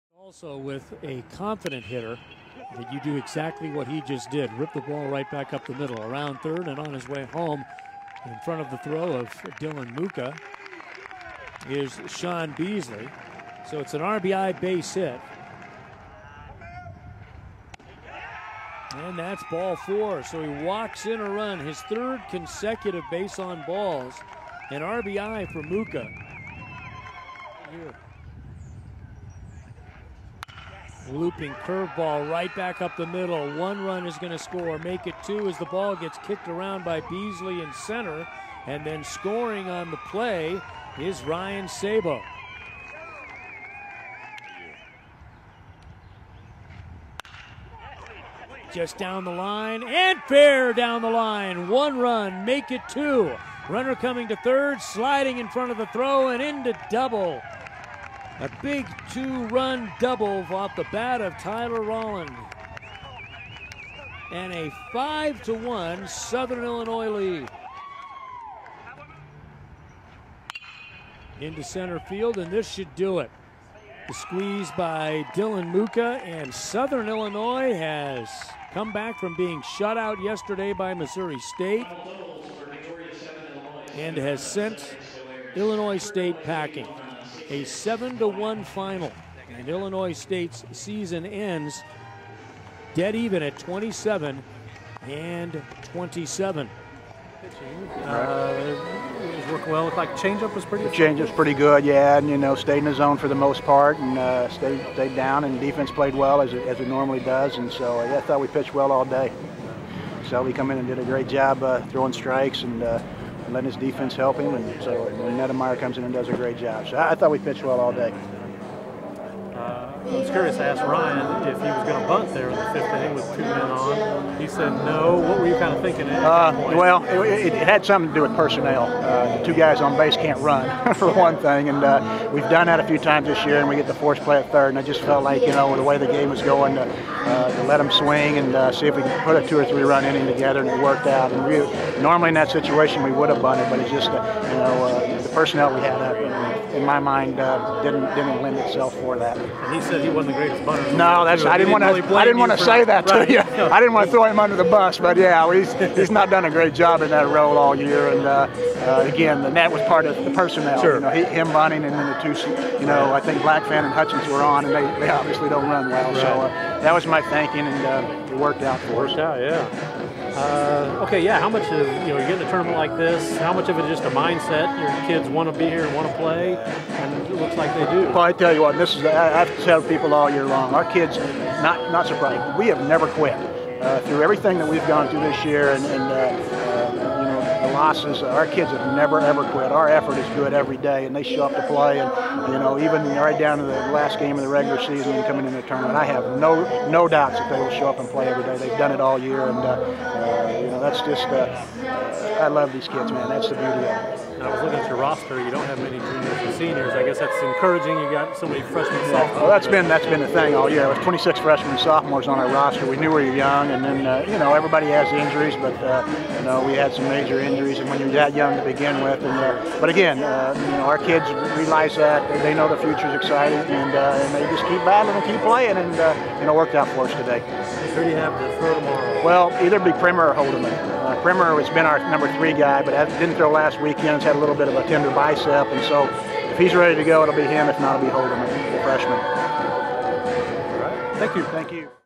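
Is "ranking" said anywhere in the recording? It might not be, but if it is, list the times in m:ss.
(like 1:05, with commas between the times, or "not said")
not said.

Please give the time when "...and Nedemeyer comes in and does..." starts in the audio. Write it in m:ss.
1:55.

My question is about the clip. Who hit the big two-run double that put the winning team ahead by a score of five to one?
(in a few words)
Tyler Rolland.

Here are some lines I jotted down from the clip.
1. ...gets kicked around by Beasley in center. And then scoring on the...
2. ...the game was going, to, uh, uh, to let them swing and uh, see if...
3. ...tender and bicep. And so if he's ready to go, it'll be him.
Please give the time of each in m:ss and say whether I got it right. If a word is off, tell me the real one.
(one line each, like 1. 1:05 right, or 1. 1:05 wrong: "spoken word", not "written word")
1. 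0:35 right
2. 2:15 right
3. 3:54 right.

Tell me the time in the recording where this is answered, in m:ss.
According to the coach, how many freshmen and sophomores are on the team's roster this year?
3:30.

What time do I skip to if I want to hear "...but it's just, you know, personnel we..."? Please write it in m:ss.
2:23.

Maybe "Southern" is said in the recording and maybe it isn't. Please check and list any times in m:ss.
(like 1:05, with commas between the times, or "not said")
1:06, 1:16.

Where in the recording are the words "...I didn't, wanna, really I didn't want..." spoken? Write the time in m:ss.
2:31.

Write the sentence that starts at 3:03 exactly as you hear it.
Uh, through everything that we've gone through this year, and, and uh, losses.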